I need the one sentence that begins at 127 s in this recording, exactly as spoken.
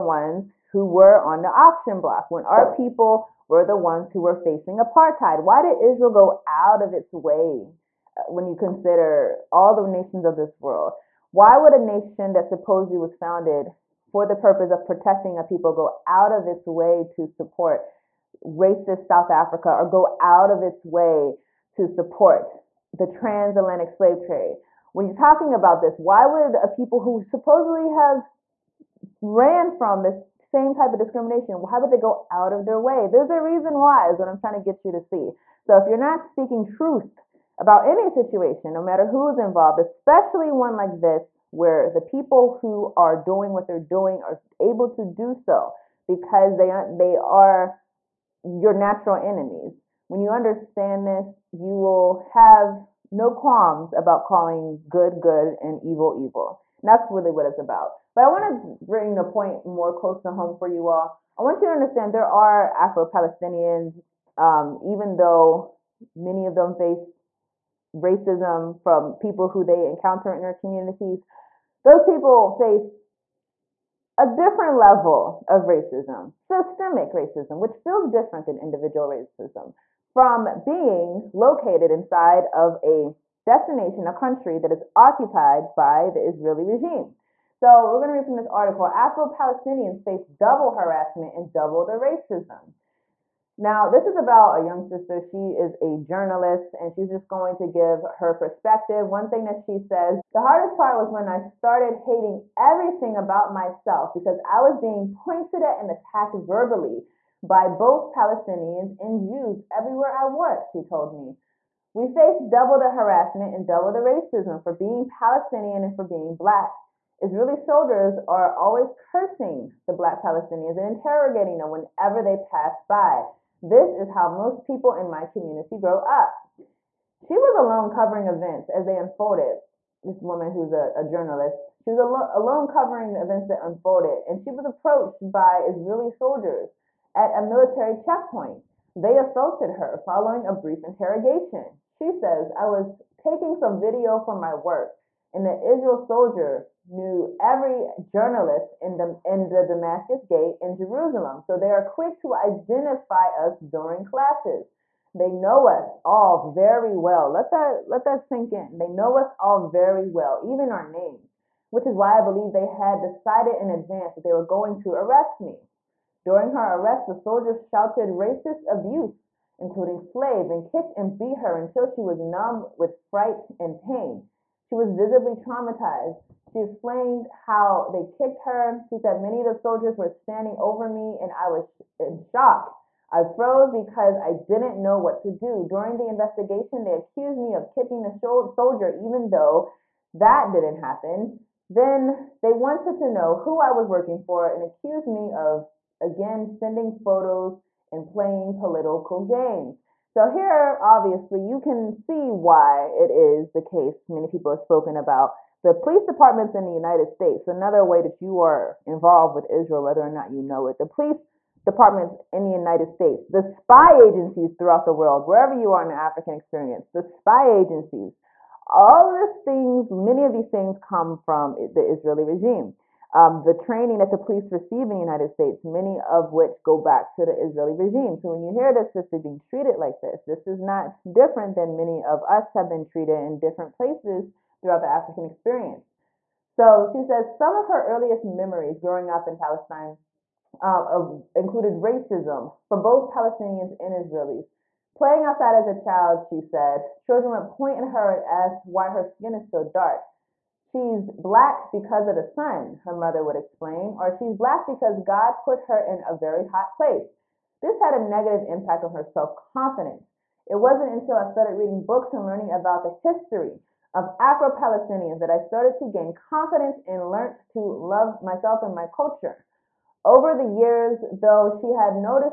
She was alone covering events as they unfolded.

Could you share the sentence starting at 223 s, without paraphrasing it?
Um, the training that the police receive in the United States, many of which go back to the Israeli regime.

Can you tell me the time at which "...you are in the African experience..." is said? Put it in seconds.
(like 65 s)
215 s.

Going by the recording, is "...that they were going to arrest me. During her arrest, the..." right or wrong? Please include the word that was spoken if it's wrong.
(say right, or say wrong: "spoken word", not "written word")
right.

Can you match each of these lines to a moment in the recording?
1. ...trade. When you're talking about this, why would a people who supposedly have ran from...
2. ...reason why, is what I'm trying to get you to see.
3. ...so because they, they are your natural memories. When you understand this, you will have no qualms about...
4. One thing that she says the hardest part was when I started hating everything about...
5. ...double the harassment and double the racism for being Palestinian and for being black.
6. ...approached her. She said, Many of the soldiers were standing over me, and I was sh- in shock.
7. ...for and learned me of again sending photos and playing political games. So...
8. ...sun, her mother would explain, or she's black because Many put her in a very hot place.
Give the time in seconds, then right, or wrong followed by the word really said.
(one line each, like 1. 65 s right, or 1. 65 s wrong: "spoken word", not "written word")
1. 24 s right
2. 33 s right
3. 45 s wrong: "enemies", not "memories"
4. 99 s right
5. 112 s right
6. 178 s wrong: "kicked", not "approached"
7. 194 s wrong: "accused", not "learned"
8. 252 s wrong: "God", not "Many".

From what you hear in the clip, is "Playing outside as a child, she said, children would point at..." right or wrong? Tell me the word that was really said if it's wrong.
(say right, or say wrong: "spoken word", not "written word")
right.